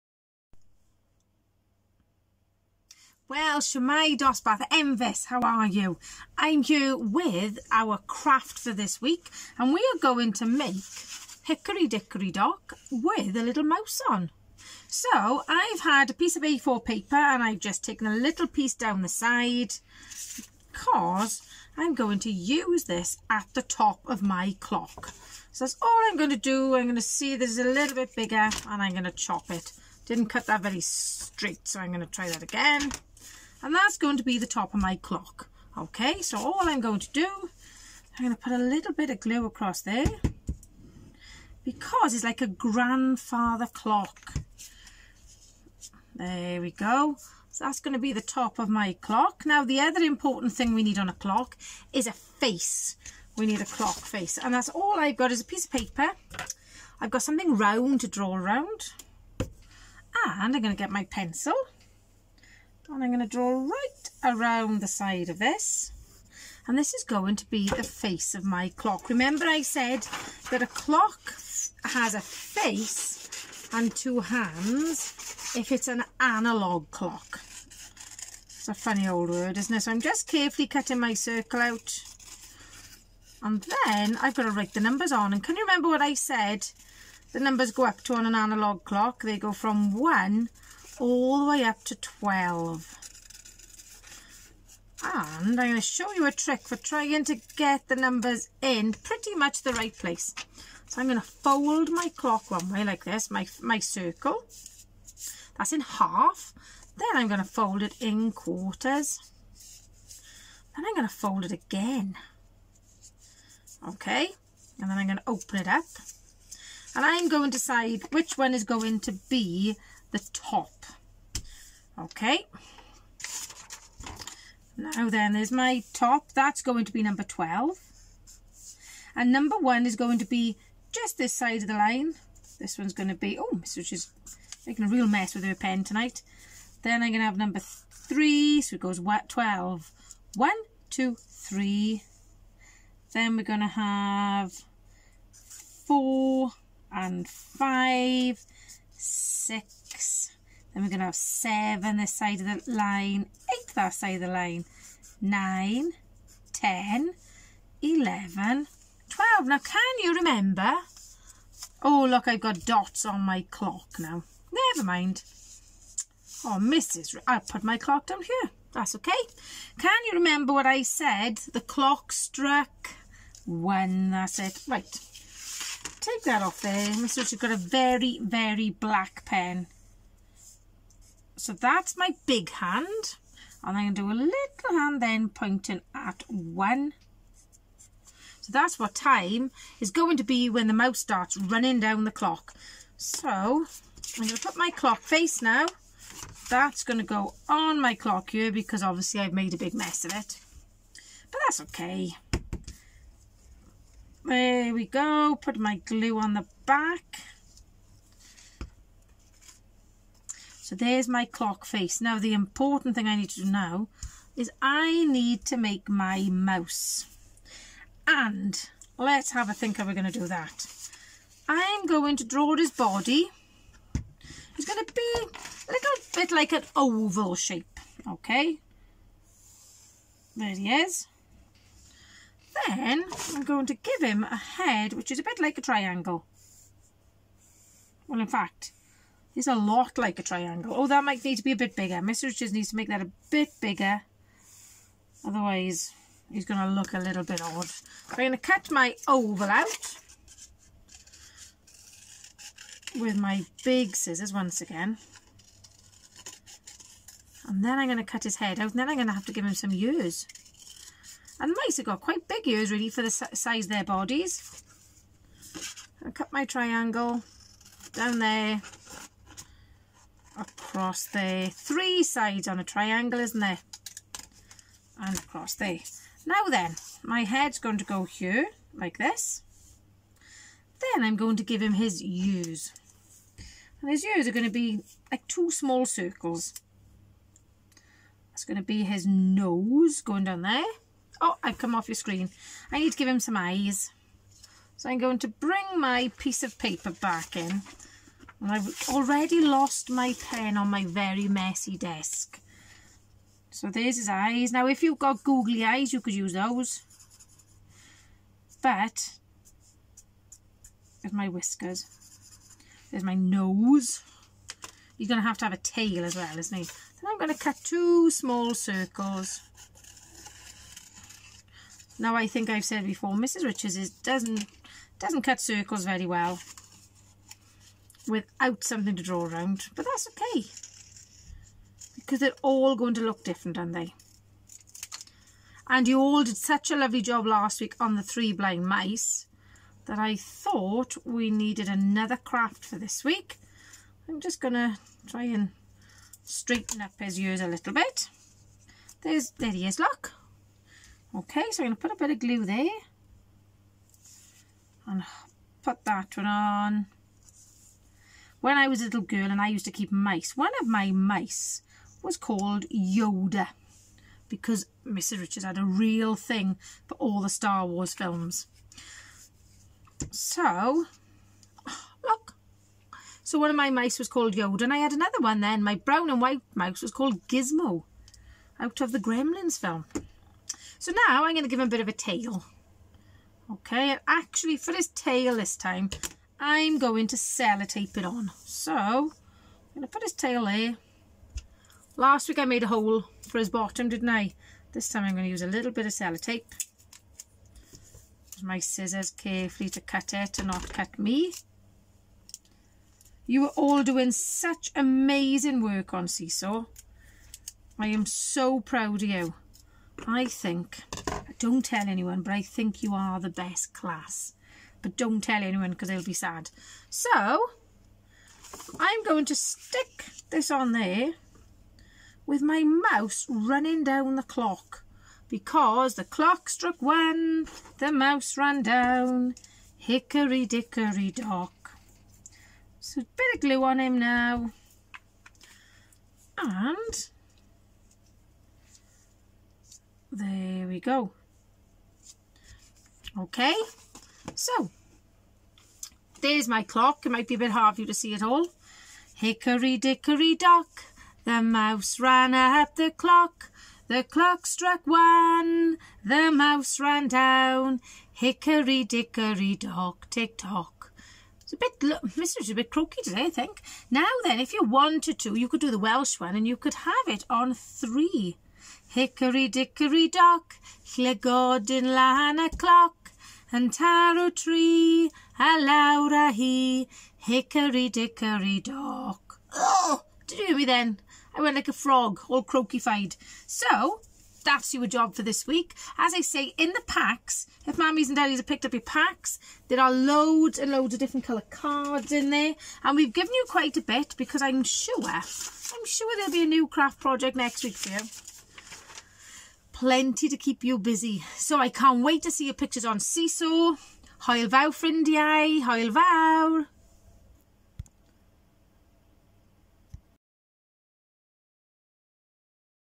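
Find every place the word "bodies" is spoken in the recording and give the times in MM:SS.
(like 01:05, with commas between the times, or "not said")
04:23.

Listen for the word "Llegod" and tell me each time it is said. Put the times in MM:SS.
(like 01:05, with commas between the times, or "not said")
07:50.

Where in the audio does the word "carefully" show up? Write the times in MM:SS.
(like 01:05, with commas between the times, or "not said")
01:20, 06:39.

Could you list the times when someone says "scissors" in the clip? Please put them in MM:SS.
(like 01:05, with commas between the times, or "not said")
04:13, 06:38.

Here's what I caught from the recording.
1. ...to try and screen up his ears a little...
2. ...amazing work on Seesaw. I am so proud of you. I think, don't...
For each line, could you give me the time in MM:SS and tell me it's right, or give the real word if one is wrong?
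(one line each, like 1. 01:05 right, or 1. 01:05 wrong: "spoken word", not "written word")
1. 05:44 wrong: "straighten", not "screen"
2. 06:44 right.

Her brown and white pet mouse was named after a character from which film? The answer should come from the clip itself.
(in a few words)
Gremlins.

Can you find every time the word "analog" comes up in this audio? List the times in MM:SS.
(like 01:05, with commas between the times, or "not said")
01:16, 01:28.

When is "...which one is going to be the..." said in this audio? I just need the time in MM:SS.
01:58.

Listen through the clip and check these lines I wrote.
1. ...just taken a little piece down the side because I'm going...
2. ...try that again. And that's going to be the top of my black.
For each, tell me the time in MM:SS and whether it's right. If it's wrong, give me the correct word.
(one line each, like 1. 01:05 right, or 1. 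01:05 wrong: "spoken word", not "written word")
1. 00:17 right
2. 00:32 wrong: "clock", not "black".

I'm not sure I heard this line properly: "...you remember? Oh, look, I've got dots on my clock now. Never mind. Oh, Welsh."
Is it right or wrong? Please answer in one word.
wrong.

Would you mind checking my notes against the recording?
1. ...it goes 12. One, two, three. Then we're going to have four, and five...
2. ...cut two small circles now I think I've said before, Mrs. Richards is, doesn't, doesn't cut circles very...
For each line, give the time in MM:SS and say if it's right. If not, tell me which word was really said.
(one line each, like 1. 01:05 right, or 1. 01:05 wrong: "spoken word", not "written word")
1. 02:18 right
2. 05:17 right.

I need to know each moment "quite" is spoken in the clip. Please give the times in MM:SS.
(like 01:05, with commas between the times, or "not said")
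04:22, 08:13.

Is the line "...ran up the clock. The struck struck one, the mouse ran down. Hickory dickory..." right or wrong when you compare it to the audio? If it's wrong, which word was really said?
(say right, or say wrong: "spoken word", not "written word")
wrong: "clock", not "struck".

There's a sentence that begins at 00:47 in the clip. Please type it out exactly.
So that's going to be the top of my clock.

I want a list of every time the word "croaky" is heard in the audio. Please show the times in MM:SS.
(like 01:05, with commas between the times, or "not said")
07:42, 08:02.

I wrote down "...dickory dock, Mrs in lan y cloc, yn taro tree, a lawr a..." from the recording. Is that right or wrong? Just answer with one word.
wrong.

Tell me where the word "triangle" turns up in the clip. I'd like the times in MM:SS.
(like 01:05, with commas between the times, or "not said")
03:55, 04:00, 04:26, 04:32.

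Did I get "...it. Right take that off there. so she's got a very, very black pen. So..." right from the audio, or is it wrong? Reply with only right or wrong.
right.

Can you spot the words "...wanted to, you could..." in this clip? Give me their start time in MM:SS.
07:44.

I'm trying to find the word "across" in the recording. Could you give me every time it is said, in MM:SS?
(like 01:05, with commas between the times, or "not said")
00:39, 04:30, 04:35.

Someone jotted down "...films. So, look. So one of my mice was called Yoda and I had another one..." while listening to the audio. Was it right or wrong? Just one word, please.
right.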